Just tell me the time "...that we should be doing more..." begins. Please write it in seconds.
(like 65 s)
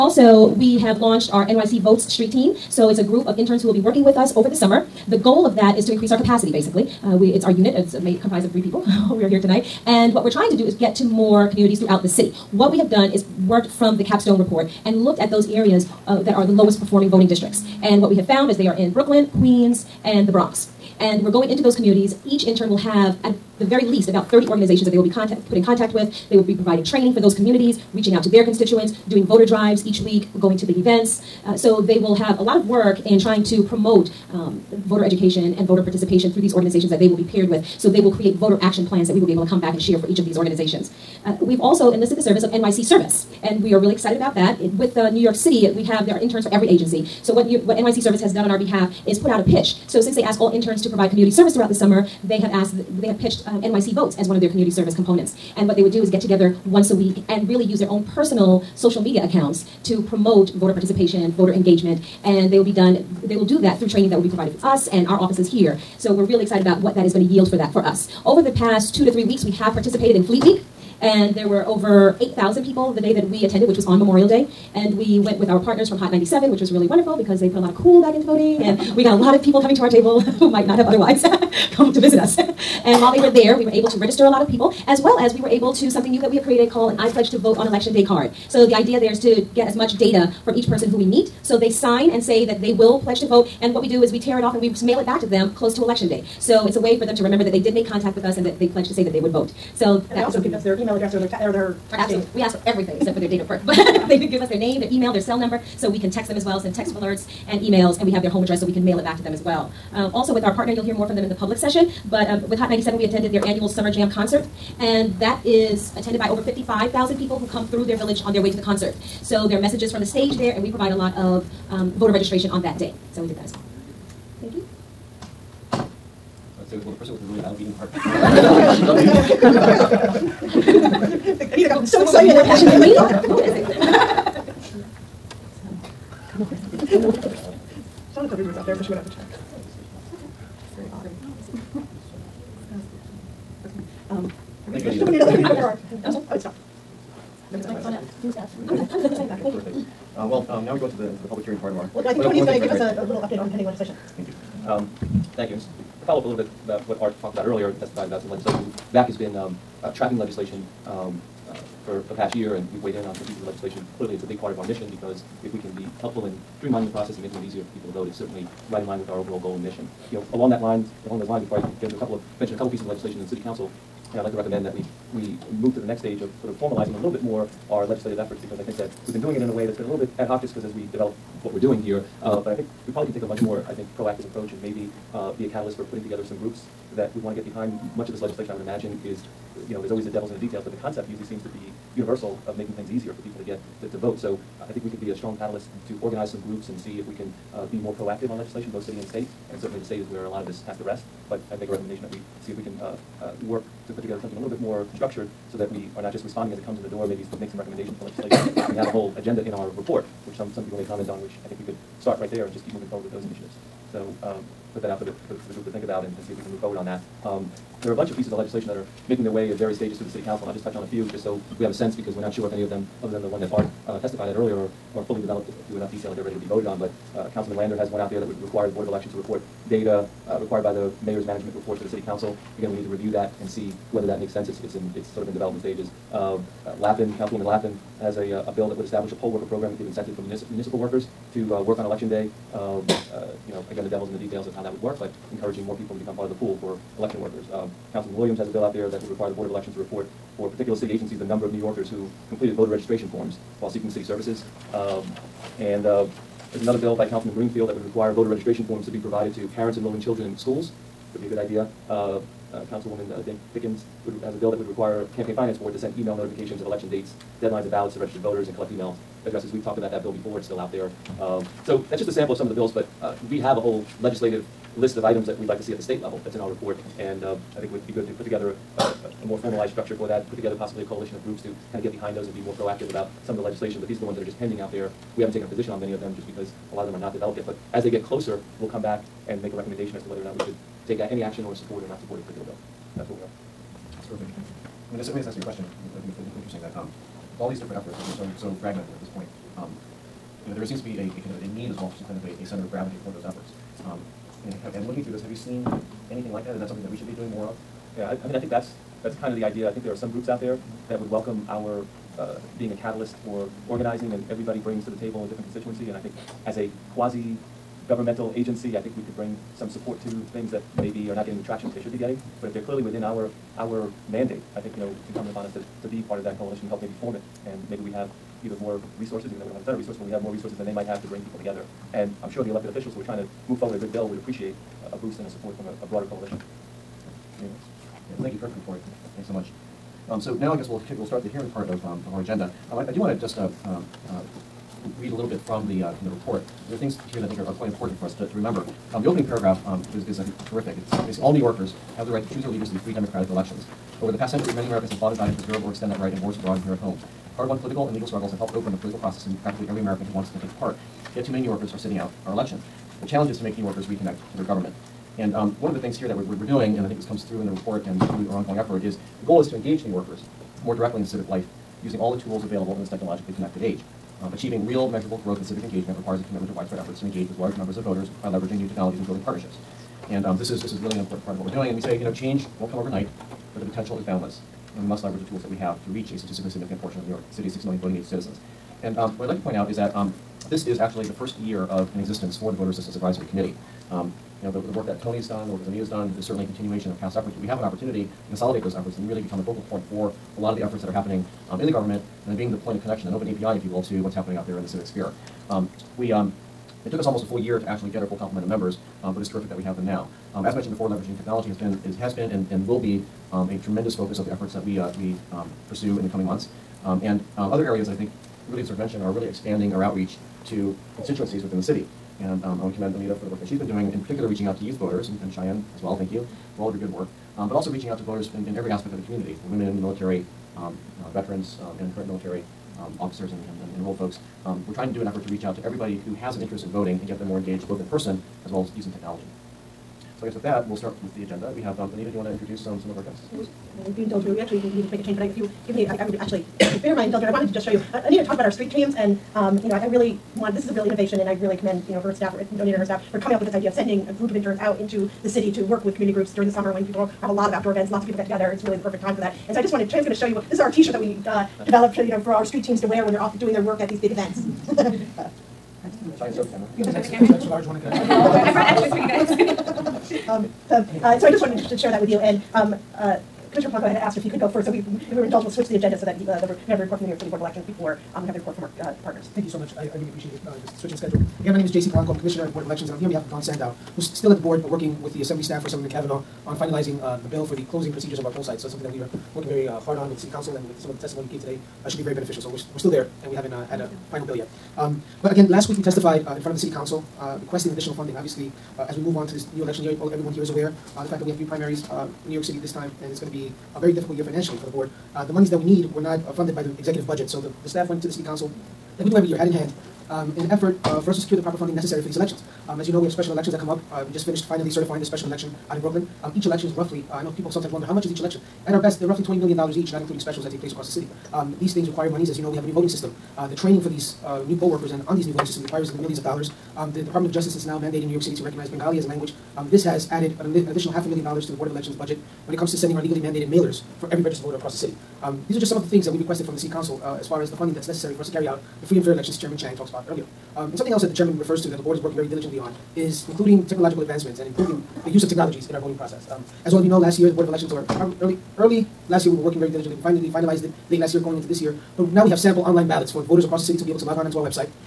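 306 s.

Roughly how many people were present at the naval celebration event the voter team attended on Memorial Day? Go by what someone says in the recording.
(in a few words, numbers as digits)
8,000.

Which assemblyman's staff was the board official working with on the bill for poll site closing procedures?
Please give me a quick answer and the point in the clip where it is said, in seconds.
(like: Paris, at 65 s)
Kavanagh, at 485 s.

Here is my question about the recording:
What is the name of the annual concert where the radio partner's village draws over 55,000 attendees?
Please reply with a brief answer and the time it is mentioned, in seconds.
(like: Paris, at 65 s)
Summer Jam, at 113 s.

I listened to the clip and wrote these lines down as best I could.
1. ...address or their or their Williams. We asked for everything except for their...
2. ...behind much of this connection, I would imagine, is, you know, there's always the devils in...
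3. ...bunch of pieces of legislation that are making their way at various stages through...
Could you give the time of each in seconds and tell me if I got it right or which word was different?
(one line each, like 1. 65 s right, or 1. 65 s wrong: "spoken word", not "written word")
1. 100 s wrong: "Absolutely", not "Williams"
2. 187 s wrong: "legislation", not "connection"
3. 217 s right.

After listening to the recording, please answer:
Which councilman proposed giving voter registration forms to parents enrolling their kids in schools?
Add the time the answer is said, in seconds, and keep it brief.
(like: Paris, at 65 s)
Greenfield, at 257 s.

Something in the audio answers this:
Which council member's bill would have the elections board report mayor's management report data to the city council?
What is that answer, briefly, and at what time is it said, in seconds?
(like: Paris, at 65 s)
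Lander, at 227 s.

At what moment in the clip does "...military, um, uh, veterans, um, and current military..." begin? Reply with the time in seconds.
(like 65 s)
429 s.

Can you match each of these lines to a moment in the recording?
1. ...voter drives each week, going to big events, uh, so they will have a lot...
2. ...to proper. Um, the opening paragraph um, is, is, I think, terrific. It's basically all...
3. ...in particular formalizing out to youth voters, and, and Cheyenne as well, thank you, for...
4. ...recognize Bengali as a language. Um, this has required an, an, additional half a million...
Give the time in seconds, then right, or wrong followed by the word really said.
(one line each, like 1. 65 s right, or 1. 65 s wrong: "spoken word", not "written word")
1. 29 s right
2. 348 s wrong: "remember", not "proper"
3. 423 s wrong: "reaching", not "formalizing"
4. 528 s wrong: "added", not "required".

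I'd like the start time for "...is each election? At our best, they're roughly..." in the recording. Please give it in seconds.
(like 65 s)
518 s.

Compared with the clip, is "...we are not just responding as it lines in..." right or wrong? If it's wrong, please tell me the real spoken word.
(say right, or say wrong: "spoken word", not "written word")
wrong: "comes", not "lines".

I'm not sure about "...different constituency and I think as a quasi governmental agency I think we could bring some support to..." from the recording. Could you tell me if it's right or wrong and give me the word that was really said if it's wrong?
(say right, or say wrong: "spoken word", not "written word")
right.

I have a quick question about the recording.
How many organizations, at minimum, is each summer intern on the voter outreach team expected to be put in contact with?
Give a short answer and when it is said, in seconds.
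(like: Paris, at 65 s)
30, at 24 s.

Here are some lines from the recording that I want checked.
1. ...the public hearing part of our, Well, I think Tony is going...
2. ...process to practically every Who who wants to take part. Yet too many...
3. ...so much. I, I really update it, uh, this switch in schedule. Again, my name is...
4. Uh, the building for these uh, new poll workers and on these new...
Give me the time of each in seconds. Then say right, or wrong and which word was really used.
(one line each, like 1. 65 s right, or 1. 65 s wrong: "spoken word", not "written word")
1. 151 s right
2. 358 s wrong: "American", not "Who"
3. 479 s wrong: "appreciate", not "update"
4. 523 s wrong: "training", not "building".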